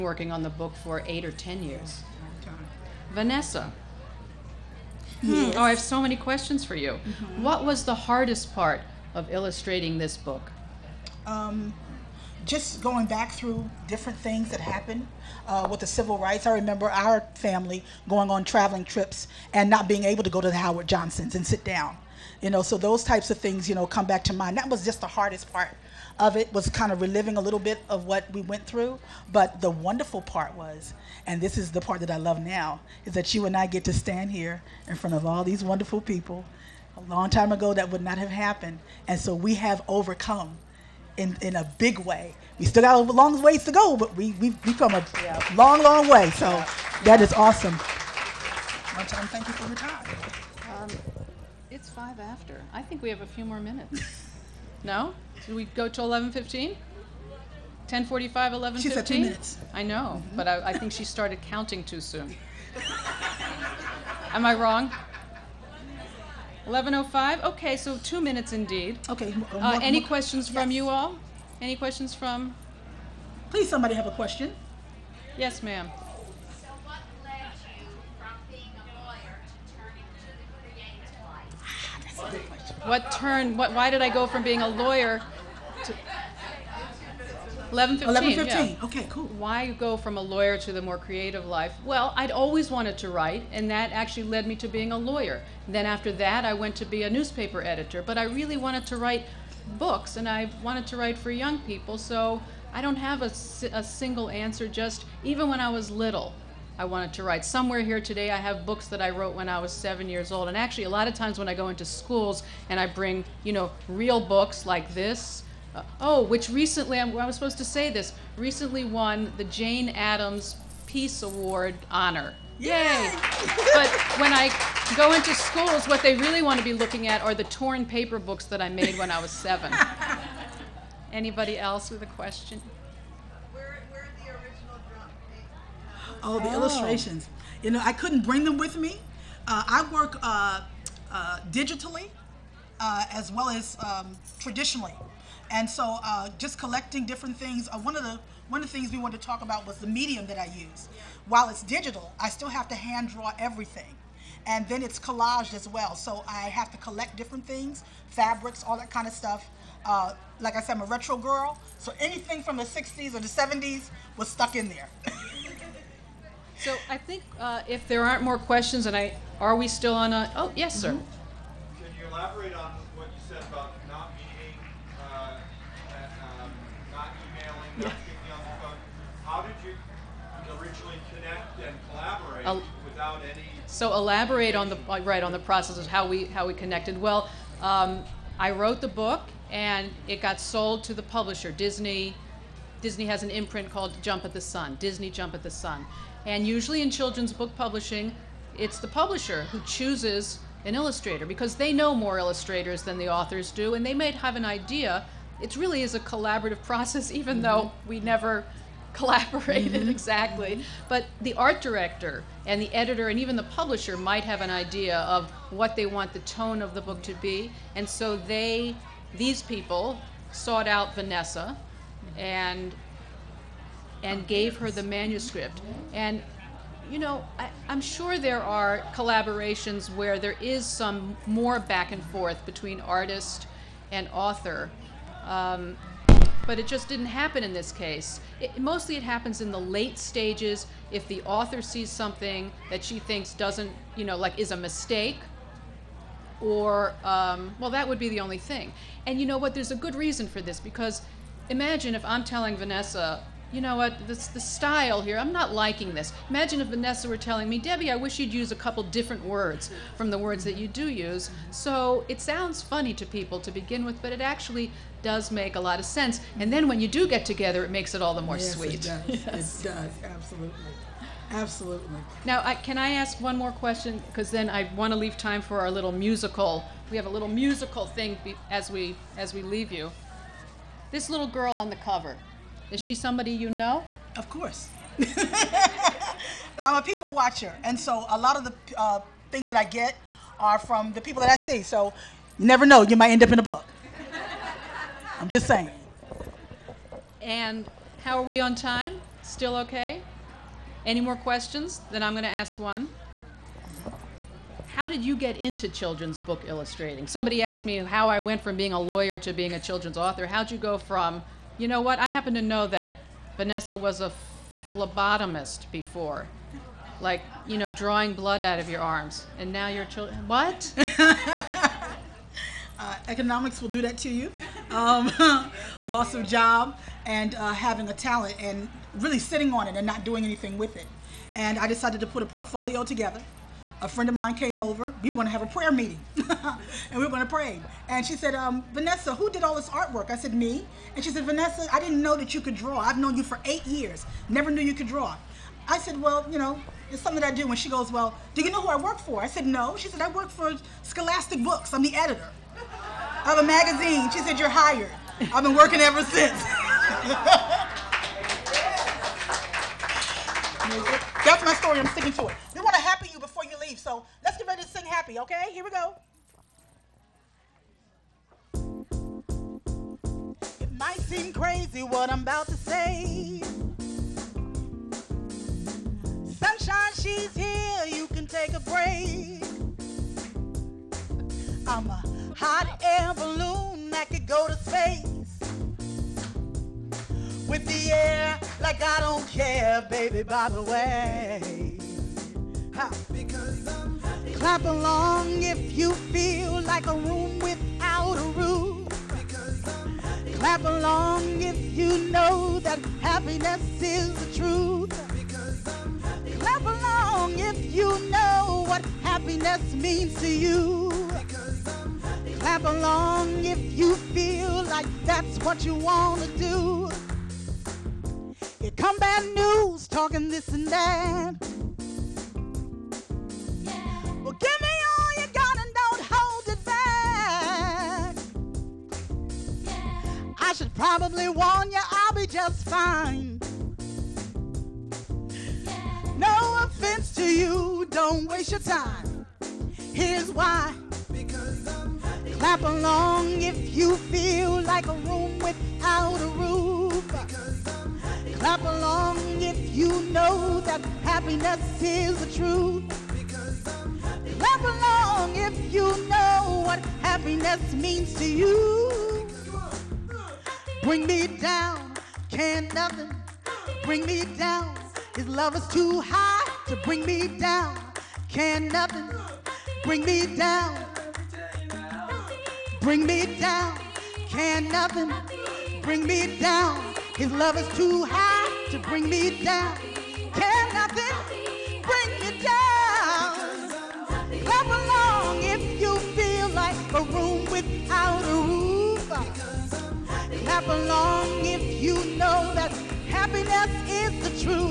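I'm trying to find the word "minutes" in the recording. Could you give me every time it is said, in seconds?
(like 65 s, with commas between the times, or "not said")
53 s, 59 s, 68 s.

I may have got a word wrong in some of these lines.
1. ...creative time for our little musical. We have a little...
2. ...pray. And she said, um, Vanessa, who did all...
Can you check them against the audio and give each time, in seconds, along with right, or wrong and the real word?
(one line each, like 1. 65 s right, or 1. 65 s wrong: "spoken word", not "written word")
1. 274 s wrong: "leave", not "creative"
2. 337 s right.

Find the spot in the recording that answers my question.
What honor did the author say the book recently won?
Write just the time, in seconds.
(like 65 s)
119 s.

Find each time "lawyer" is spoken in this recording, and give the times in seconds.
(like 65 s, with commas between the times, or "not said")
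79 s, 84 s, 90 s, 94 s, 308 s.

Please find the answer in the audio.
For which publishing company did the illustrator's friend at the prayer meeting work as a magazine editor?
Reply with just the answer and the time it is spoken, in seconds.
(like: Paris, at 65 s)
Scholastic Books, at 350 s.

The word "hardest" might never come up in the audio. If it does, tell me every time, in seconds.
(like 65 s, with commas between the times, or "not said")
8 s, 25 s.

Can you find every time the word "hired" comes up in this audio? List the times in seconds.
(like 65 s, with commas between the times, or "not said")
354 s.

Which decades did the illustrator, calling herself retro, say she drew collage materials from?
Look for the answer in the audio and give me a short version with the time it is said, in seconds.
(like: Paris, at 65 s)
the 60s and 70s, at 162 s.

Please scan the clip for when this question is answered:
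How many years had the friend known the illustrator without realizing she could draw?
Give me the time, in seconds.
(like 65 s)
343 s.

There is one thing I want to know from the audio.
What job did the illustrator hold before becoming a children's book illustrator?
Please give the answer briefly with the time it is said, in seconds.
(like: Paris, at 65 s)
Phlebotomist, at 314 s.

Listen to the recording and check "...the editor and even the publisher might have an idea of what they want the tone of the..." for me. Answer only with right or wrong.
right.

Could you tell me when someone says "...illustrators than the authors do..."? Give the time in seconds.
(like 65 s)
202 s.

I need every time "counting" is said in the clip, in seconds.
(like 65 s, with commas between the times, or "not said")
61 s.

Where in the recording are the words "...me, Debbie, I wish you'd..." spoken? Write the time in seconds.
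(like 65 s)
257 s.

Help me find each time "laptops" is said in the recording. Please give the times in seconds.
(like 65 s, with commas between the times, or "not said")
not said.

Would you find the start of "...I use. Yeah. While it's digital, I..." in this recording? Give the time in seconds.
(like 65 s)
150 s.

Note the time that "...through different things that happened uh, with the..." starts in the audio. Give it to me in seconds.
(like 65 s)
13 s.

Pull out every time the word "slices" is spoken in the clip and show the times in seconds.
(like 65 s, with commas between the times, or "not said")
not said.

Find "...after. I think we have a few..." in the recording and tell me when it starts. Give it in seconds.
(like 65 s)
52 s.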